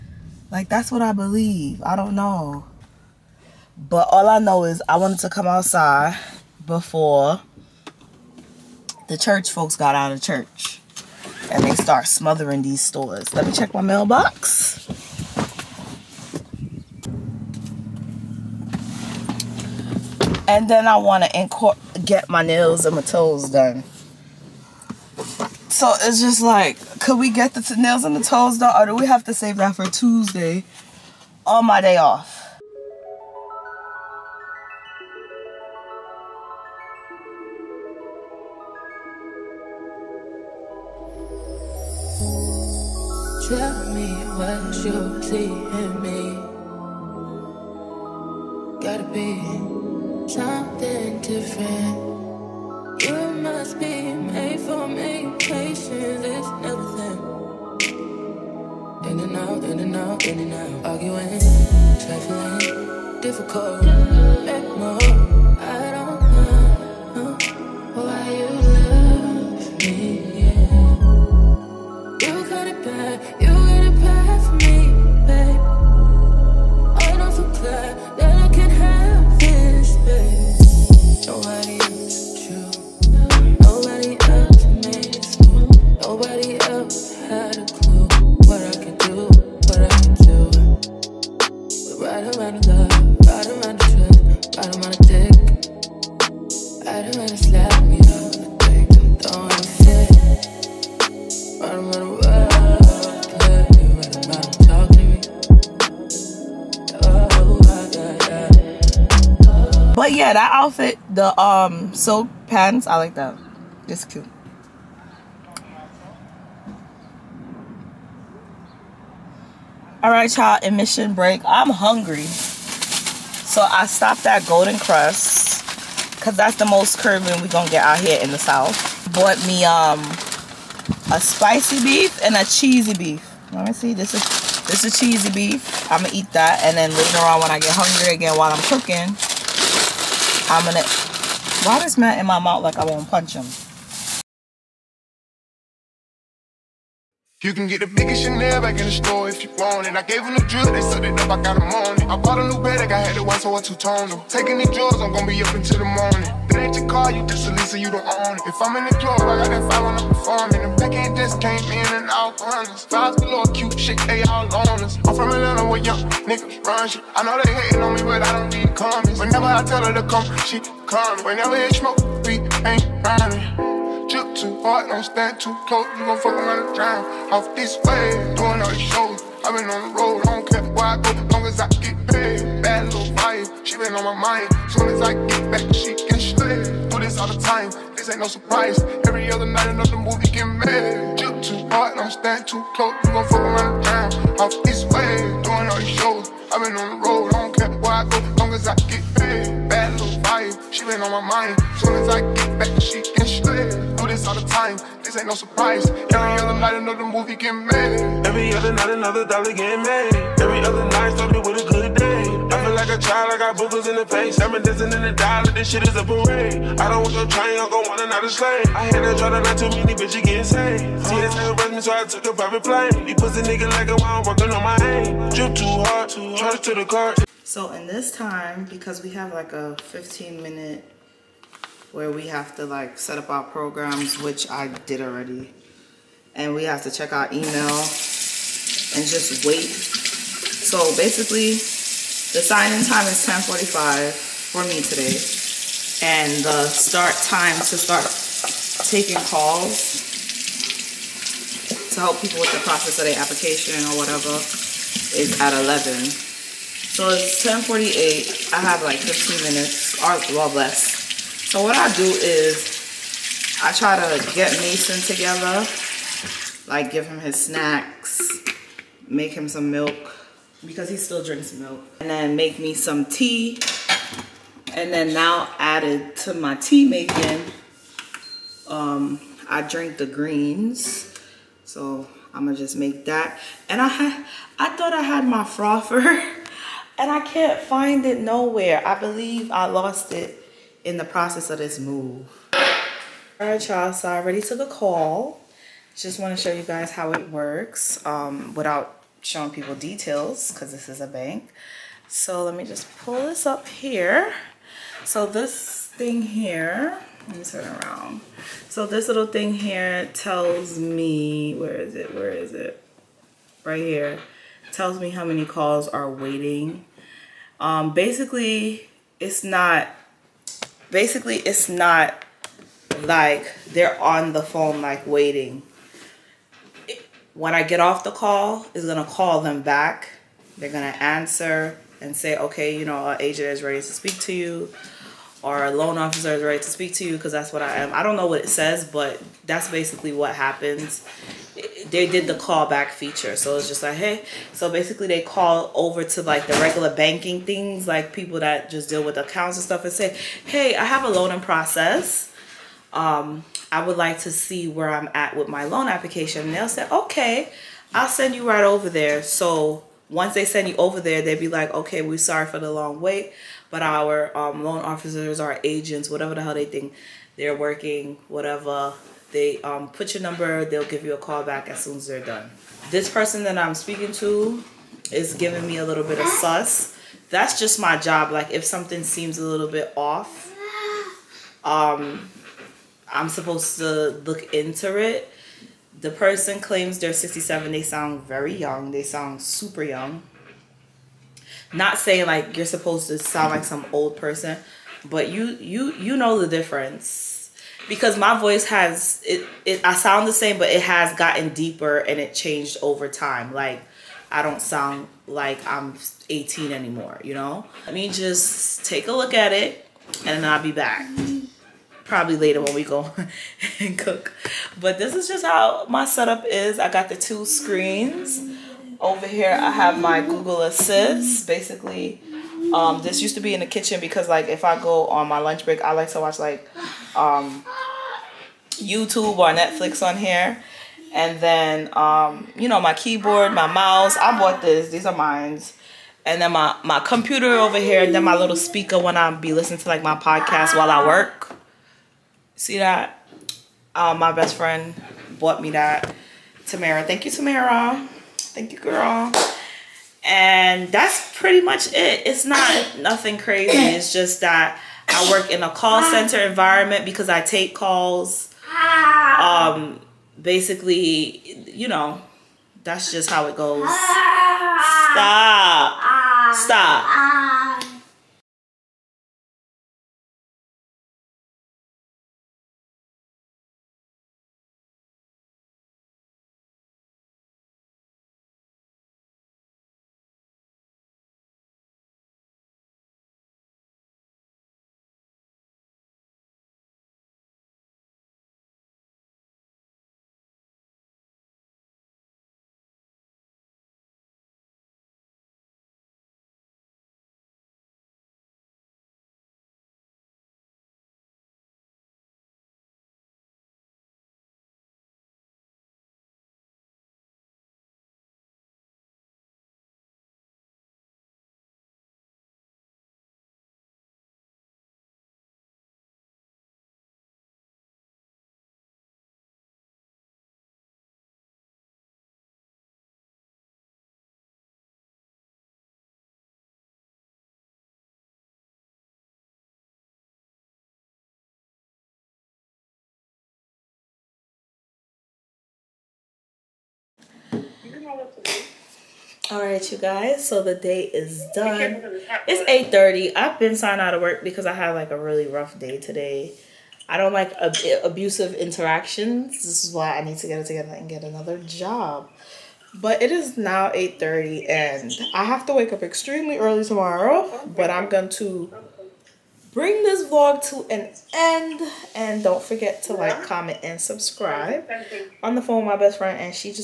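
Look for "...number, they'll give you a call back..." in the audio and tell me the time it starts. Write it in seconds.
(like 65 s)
370 s.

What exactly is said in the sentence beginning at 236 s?
And we have to check our email and just wait.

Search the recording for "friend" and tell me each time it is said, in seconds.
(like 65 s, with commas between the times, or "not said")
444 s, 566 s.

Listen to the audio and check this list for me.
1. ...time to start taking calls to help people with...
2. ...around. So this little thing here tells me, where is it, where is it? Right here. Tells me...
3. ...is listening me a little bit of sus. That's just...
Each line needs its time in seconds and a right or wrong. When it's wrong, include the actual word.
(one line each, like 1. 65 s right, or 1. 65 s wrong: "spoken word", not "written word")
1. 247 s right
2. 307 s right
3. 375 s wrong: "giving", not "listening".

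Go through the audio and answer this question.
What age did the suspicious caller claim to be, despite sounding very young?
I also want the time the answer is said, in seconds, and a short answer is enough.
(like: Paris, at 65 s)
67, at 387 s.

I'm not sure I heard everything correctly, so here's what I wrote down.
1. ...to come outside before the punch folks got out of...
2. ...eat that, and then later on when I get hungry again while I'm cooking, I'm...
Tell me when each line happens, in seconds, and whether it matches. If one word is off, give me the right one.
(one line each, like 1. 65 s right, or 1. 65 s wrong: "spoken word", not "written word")
1. 5 s wrong: "church", not "punch"
2. 136 s right.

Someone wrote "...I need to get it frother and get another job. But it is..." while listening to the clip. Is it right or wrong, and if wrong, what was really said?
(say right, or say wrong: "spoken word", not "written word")
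wrong: "together", not "frother".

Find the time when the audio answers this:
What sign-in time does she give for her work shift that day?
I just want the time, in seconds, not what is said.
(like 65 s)
243 s.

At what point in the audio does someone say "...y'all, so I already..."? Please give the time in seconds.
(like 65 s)
293 s.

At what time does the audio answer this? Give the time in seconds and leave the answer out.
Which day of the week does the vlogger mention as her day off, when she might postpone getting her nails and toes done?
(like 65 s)
29 s.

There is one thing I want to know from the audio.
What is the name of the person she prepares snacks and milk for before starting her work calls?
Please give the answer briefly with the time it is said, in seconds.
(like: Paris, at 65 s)
Mason, at 264 s.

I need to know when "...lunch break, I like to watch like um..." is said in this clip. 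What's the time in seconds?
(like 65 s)
425 s.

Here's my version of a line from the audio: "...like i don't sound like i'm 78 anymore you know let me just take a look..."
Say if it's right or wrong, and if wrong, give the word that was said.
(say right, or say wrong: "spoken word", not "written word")
wrong: "18", not "78".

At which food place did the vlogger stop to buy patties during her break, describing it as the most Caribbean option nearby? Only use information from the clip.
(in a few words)
Golden Krust.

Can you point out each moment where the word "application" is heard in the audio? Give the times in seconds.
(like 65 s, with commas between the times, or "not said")
253 s, 355 s.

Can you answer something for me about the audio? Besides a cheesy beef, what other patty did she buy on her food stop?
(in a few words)
spicy beef.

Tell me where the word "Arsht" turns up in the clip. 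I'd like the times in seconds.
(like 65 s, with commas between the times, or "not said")
not said.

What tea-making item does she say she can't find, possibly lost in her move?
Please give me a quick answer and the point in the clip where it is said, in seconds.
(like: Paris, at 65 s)
frother, at 285 s.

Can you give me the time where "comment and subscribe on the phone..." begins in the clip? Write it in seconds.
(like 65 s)
563 s.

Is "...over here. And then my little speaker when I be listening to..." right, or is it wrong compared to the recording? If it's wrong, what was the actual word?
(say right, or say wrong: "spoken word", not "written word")
right.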